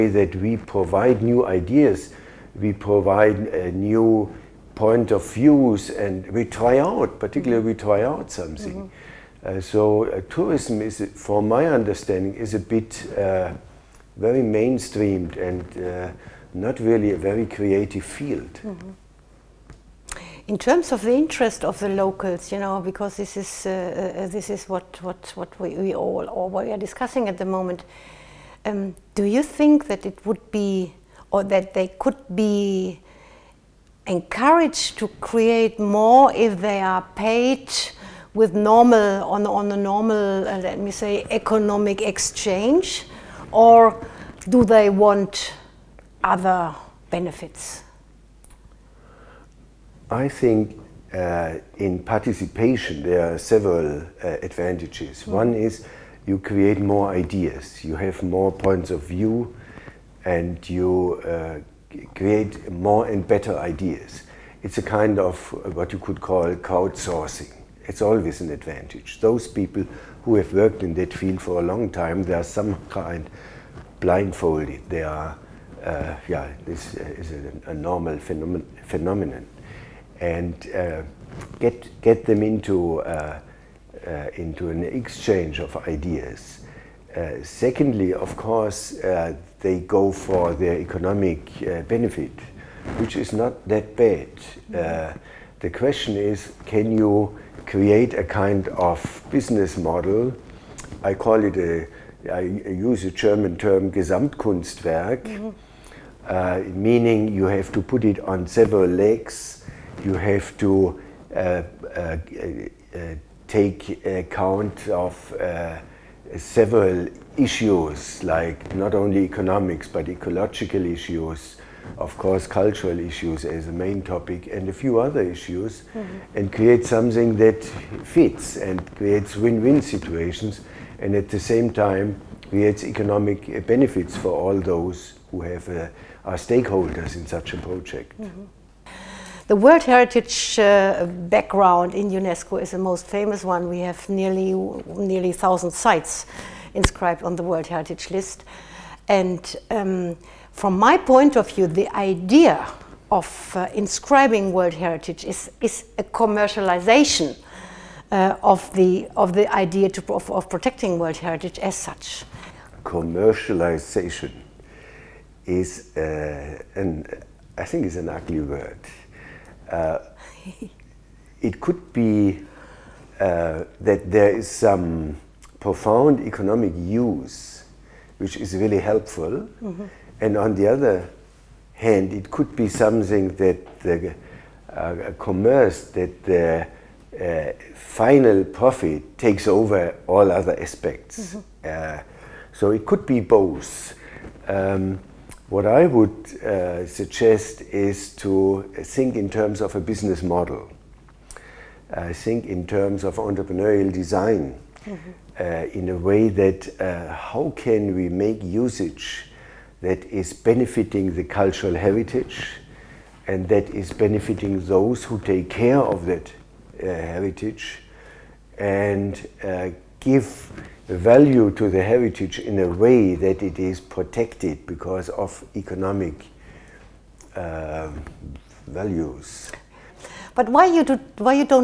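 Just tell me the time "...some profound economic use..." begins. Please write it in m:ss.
2:54.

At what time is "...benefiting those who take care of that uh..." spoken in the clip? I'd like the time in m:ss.
3:33.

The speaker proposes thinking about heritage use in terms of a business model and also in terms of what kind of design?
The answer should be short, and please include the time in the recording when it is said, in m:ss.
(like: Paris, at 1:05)
entrepreneurial design, at 3:23.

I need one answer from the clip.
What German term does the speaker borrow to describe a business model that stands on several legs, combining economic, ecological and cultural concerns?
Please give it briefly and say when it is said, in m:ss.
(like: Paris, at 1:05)
Gesamtkunstwerk, at 1:43.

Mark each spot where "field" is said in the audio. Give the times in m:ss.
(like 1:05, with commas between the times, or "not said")
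0:18, 1:11.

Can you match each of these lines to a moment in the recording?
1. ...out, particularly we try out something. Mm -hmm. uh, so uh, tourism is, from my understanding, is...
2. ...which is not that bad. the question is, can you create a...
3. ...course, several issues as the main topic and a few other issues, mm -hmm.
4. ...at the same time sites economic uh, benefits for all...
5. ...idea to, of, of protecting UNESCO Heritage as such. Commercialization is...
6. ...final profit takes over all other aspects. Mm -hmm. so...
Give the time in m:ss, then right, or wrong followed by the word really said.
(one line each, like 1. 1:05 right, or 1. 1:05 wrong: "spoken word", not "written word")
1. 0:06 right
2. 1:32 right
3. 2:02 wrong: "cultural", not "several"
4. 2:11 wrong: "creates", not "sites"
5. 2:39 wrong: "World", not "UNESCO"
6. 3:07 right.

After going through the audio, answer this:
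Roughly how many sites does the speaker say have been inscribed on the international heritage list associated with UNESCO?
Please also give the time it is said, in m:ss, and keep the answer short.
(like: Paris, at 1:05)
nearly 1000, at 2:24.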